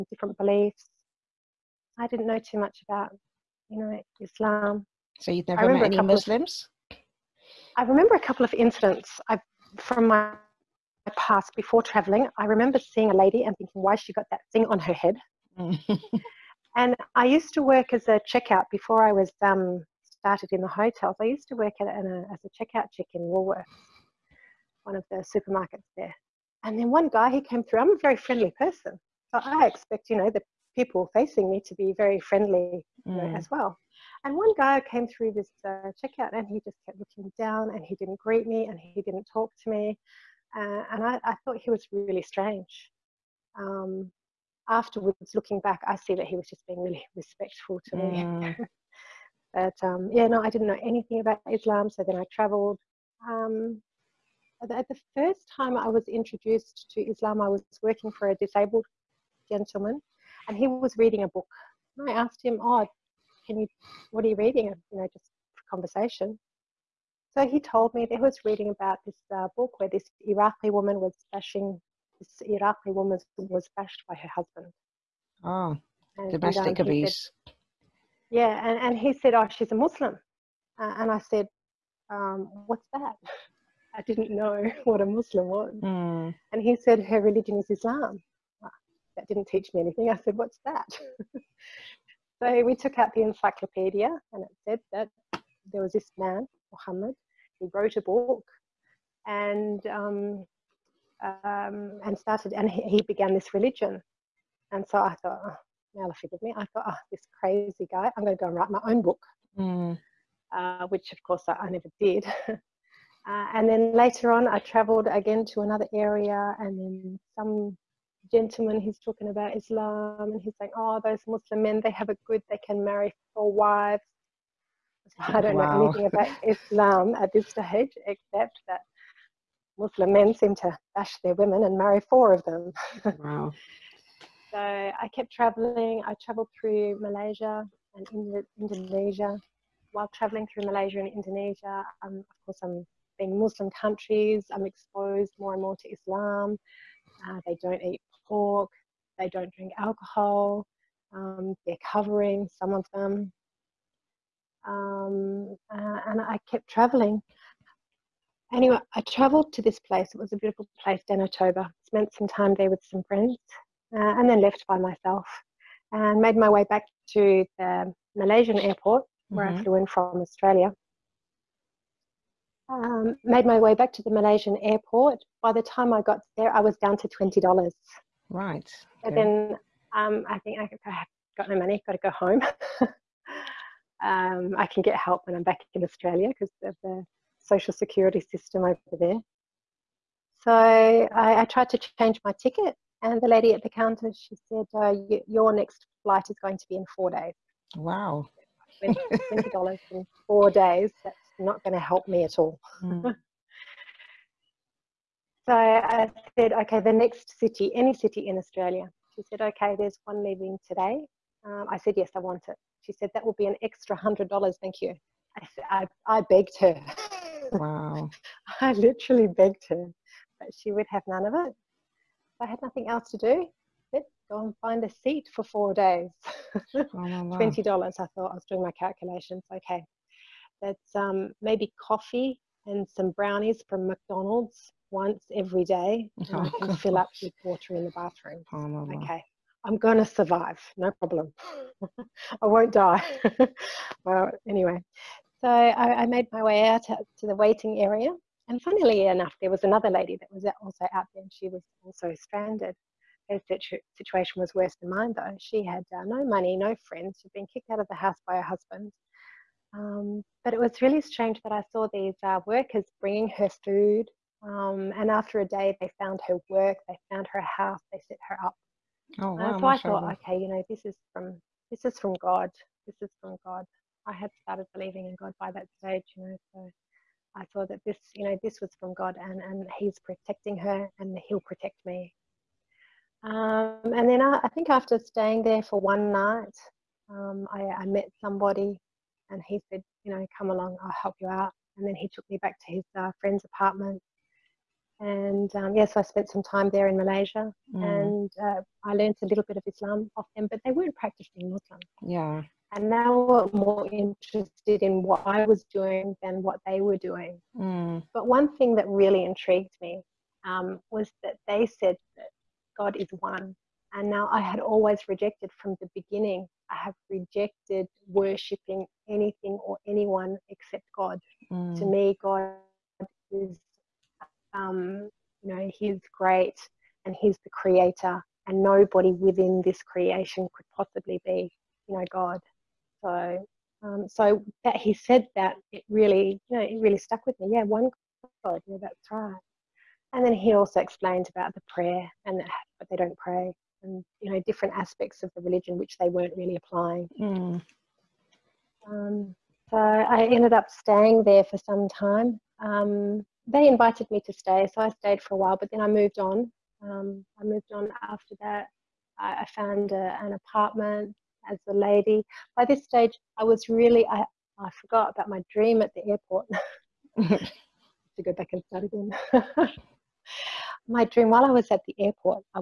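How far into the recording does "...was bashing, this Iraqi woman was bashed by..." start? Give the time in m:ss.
1:11.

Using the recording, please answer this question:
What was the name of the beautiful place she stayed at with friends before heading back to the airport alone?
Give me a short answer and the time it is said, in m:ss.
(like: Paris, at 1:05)
Danau Toba, at 2:41.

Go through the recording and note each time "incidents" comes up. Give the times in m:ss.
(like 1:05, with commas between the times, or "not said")
0:08.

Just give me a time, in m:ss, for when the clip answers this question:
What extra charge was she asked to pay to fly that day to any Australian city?
3:33.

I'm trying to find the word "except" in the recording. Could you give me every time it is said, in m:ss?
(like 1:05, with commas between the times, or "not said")
2:08, 5:20.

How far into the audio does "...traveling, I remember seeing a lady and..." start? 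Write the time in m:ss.
0:11.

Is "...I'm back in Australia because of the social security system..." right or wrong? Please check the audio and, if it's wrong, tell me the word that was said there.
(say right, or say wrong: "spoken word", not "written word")
right.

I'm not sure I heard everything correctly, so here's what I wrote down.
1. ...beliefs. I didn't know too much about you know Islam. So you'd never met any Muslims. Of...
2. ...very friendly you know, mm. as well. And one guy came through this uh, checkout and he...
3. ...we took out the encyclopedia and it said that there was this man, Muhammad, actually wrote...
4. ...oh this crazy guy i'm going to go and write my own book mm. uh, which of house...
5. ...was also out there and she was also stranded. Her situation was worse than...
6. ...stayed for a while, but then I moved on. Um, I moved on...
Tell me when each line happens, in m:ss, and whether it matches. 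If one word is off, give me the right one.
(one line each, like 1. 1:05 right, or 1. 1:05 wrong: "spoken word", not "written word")
1. 0:00 right
2. 0:31 right
3. 1:32 right
4. 1:46 wrong: "course", not "house"
5. 4:10 right
6. 5:54 right.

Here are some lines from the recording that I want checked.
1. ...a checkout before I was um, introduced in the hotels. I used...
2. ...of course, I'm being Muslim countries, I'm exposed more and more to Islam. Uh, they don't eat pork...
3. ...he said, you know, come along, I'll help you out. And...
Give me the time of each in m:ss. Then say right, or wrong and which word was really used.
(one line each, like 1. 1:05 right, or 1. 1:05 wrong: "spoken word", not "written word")
1. 0:18 wrong: "started", not "introduced"
2. 2:22 right
3. 4:49 right.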